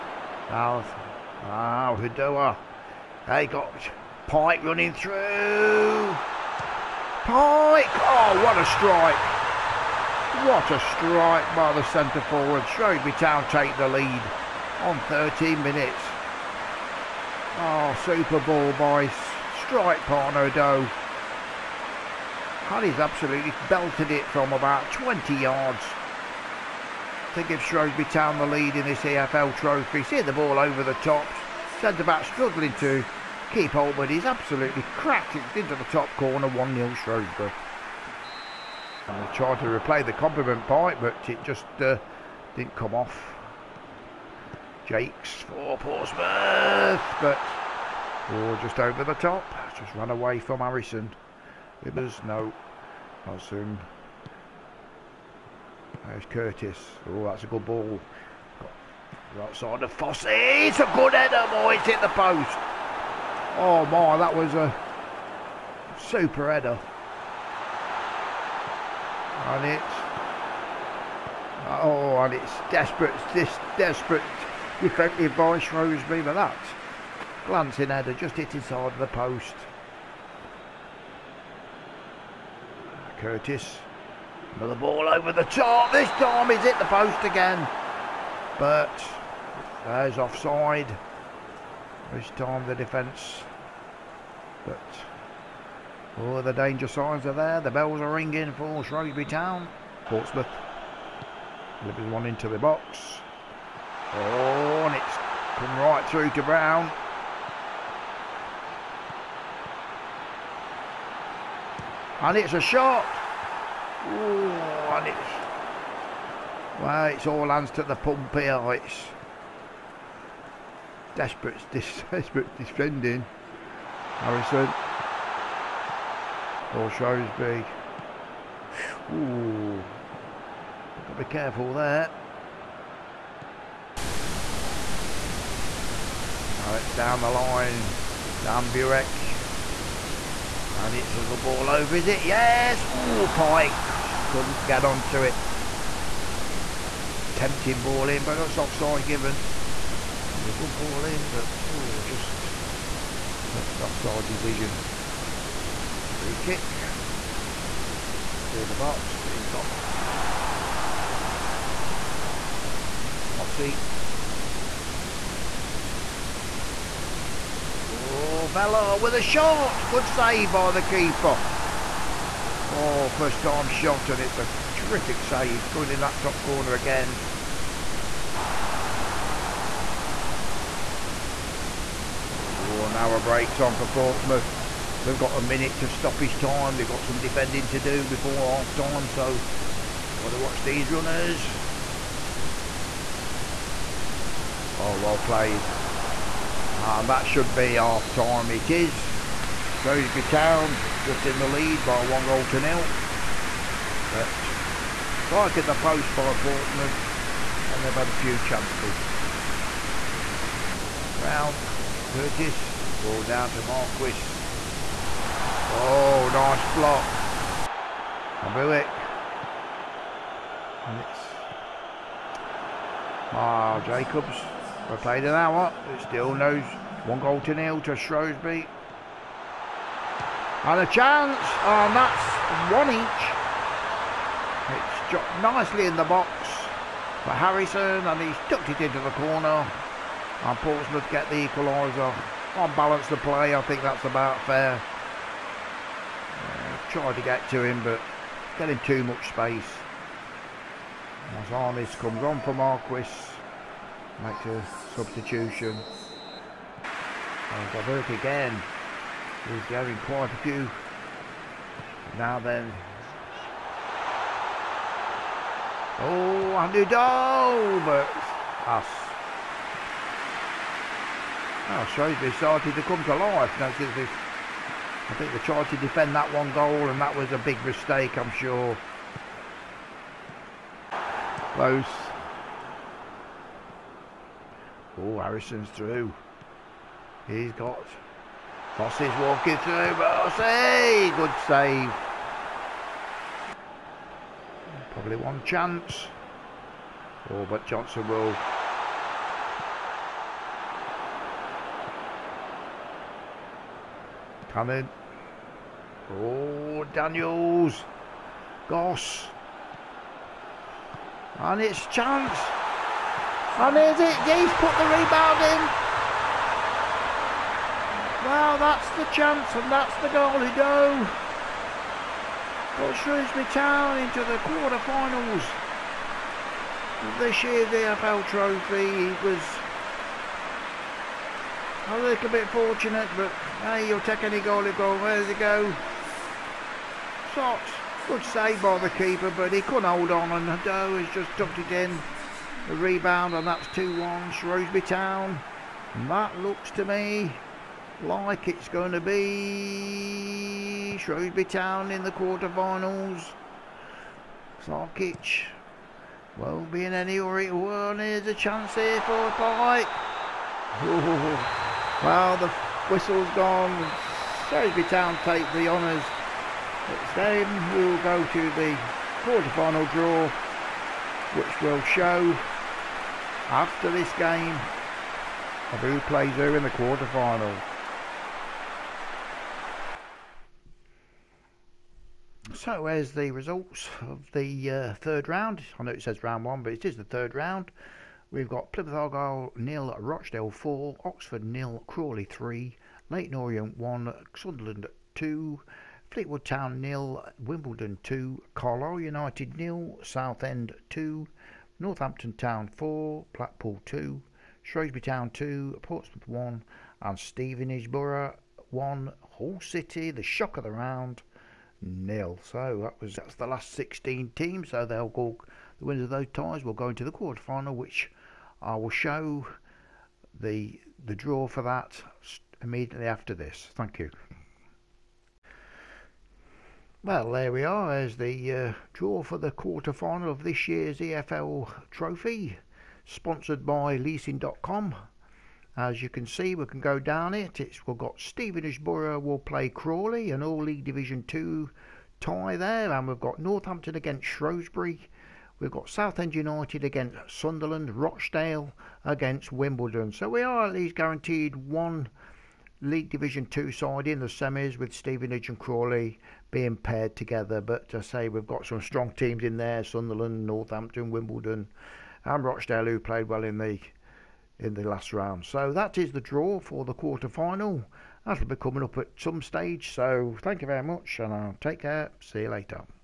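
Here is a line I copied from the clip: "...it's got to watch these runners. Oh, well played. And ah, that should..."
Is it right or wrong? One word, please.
right.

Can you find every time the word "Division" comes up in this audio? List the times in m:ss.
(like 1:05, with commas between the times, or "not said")
7:20, 7:33.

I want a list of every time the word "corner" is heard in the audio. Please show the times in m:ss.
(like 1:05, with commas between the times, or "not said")
0:36, 2:56, 3:59.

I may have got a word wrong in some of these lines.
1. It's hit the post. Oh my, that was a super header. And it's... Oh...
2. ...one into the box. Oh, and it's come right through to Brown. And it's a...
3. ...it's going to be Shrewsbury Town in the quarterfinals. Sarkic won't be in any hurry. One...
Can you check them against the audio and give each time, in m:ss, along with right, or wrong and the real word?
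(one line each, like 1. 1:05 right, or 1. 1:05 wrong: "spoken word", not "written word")
1. 1:01 right
2. 1:42 right
3. 5:48 right.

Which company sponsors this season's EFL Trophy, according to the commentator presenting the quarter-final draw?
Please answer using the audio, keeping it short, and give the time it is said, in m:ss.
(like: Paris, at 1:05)
leasing.com, at 7:13.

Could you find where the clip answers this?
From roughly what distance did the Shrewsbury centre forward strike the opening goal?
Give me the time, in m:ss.
0:24.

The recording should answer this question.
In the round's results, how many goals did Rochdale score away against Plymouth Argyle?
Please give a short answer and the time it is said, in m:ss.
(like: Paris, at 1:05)
4, at 6:29.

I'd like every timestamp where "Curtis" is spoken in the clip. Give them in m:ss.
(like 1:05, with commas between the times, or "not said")
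0:56, 1:23, 3:32.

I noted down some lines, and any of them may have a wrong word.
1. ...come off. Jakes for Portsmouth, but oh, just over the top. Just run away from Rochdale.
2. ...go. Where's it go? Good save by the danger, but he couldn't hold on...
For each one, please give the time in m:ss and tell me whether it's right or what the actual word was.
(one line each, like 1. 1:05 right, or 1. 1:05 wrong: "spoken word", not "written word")
1. 0:42 wrong: "Harrison", not "Rochdale"
2. 5:34 wrong: "keeper", not "danger".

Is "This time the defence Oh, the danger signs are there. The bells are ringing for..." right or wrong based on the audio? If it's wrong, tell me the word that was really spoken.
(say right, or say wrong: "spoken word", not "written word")
right.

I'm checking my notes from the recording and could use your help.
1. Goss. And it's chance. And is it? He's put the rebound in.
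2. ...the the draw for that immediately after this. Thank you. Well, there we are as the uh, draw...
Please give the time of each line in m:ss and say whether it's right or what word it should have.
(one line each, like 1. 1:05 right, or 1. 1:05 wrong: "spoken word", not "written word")
1. 5:08 right
2. 7:00 right.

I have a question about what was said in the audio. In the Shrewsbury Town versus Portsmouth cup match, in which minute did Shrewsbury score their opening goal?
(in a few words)
13.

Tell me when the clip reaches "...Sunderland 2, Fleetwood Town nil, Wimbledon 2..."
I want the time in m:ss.
6:34.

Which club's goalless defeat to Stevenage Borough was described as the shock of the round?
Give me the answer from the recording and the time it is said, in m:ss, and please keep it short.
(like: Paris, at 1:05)
Hull City, at 6:49.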